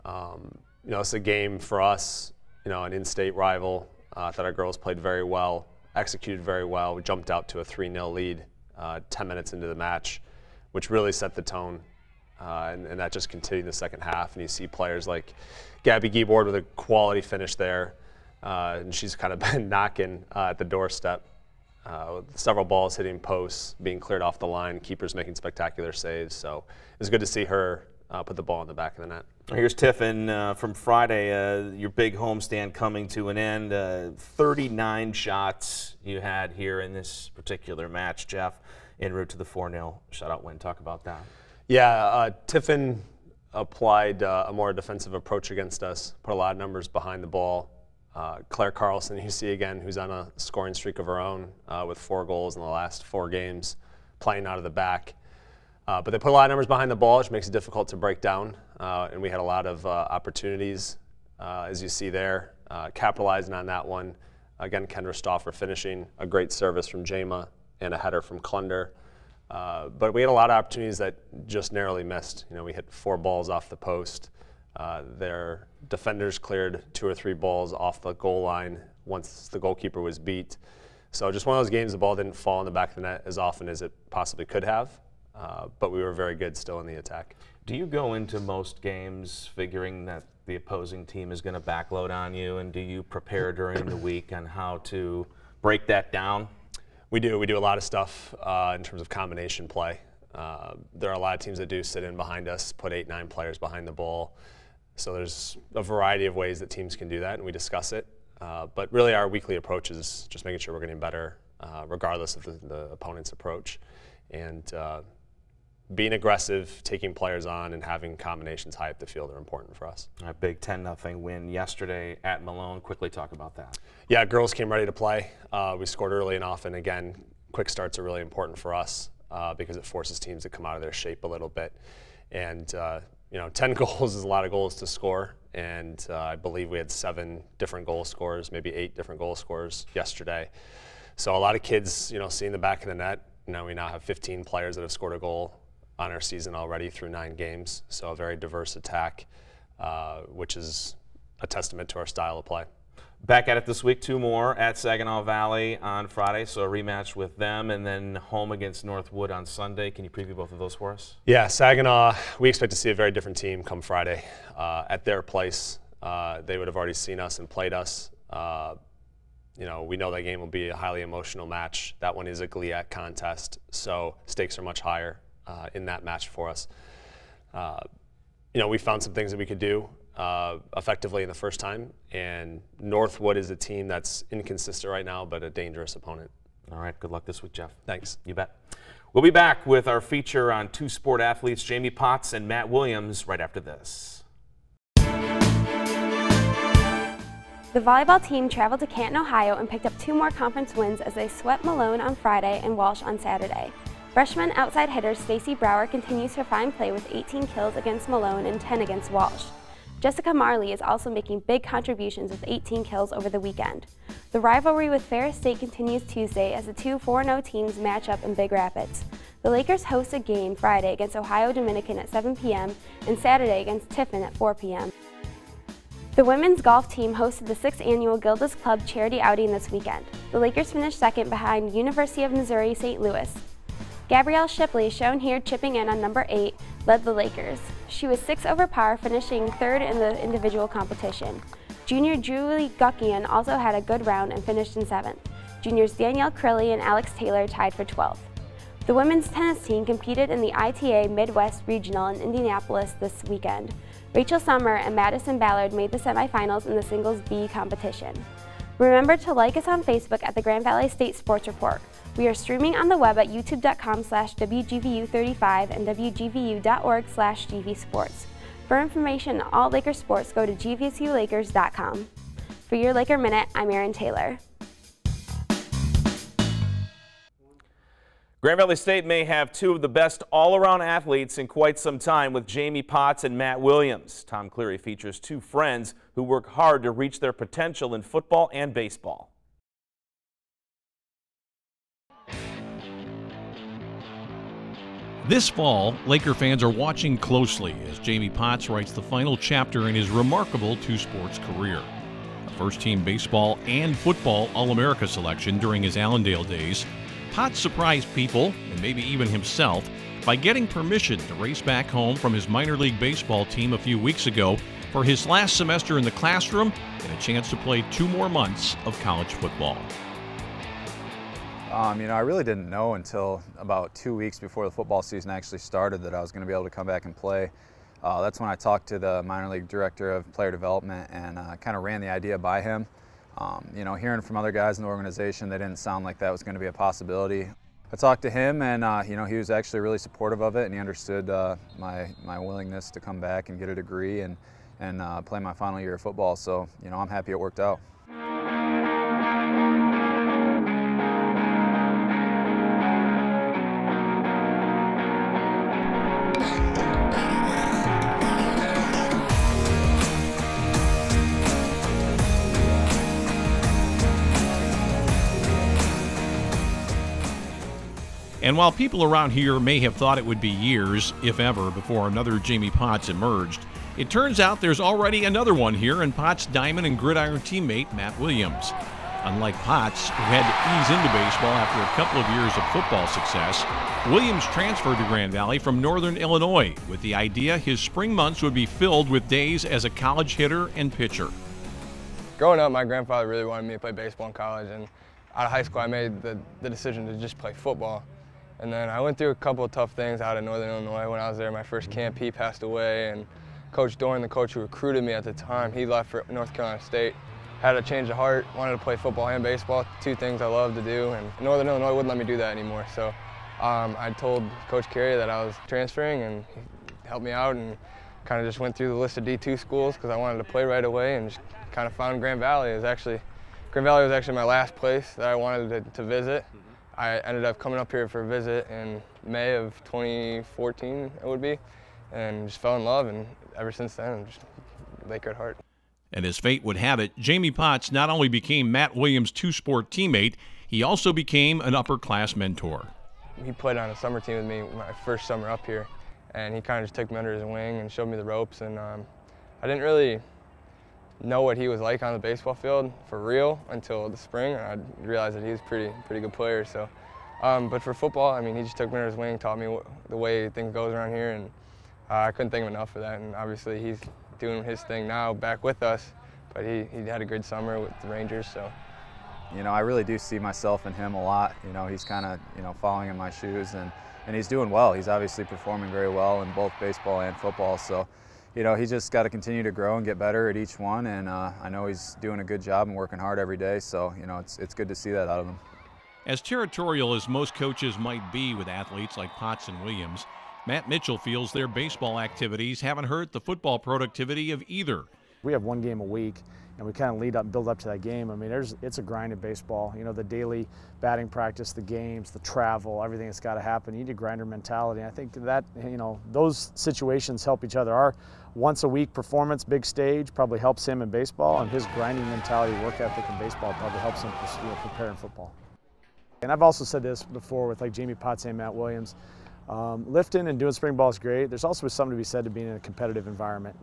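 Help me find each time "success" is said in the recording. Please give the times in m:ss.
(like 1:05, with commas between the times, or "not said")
6:23.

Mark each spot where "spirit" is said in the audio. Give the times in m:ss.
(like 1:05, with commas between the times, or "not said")
not said.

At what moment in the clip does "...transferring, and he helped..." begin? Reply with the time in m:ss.
6:55.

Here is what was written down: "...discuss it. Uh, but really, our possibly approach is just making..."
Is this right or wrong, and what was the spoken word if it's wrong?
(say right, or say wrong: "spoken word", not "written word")
wrong: "weekly", not "possibly".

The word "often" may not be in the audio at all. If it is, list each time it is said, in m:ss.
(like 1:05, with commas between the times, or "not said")
1:23, 2:06.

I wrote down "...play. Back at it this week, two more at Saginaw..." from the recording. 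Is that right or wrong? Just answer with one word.
right.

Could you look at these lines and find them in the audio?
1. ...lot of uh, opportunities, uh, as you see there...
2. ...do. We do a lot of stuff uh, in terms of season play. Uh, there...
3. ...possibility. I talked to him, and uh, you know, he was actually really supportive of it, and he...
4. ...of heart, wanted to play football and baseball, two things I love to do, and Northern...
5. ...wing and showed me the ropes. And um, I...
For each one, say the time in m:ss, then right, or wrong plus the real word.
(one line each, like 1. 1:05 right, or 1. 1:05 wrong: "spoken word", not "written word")
1. 0:59 right
2. 1:37 wrong: "combination", not "season"
3. 5:36 right
4. 6:48 right
5. 7:27 right.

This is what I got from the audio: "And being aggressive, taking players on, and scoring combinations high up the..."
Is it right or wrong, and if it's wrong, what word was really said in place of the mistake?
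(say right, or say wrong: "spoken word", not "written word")
wrong: "having", not "scoring".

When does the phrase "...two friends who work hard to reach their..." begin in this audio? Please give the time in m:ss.
4:45.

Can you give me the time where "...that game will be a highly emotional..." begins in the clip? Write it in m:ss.
2:50.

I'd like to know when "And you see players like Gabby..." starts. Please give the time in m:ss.
0:14.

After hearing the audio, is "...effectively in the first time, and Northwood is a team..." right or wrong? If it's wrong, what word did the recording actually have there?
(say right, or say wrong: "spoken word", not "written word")
right.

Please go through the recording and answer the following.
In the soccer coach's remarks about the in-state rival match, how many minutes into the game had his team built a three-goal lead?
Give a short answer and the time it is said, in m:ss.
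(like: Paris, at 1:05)
10, at 0:09.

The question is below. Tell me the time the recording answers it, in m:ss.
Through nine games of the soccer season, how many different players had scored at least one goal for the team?
2:24.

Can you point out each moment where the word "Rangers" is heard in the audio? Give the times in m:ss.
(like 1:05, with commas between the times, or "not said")
7:48.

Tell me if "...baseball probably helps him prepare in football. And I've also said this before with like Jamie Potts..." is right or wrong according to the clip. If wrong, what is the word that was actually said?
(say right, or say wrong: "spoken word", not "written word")
right.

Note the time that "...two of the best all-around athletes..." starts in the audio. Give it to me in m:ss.
4:39.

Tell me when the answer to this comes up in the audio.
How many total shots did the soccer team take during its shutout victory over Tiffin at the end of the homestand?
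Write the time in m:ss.
0:34.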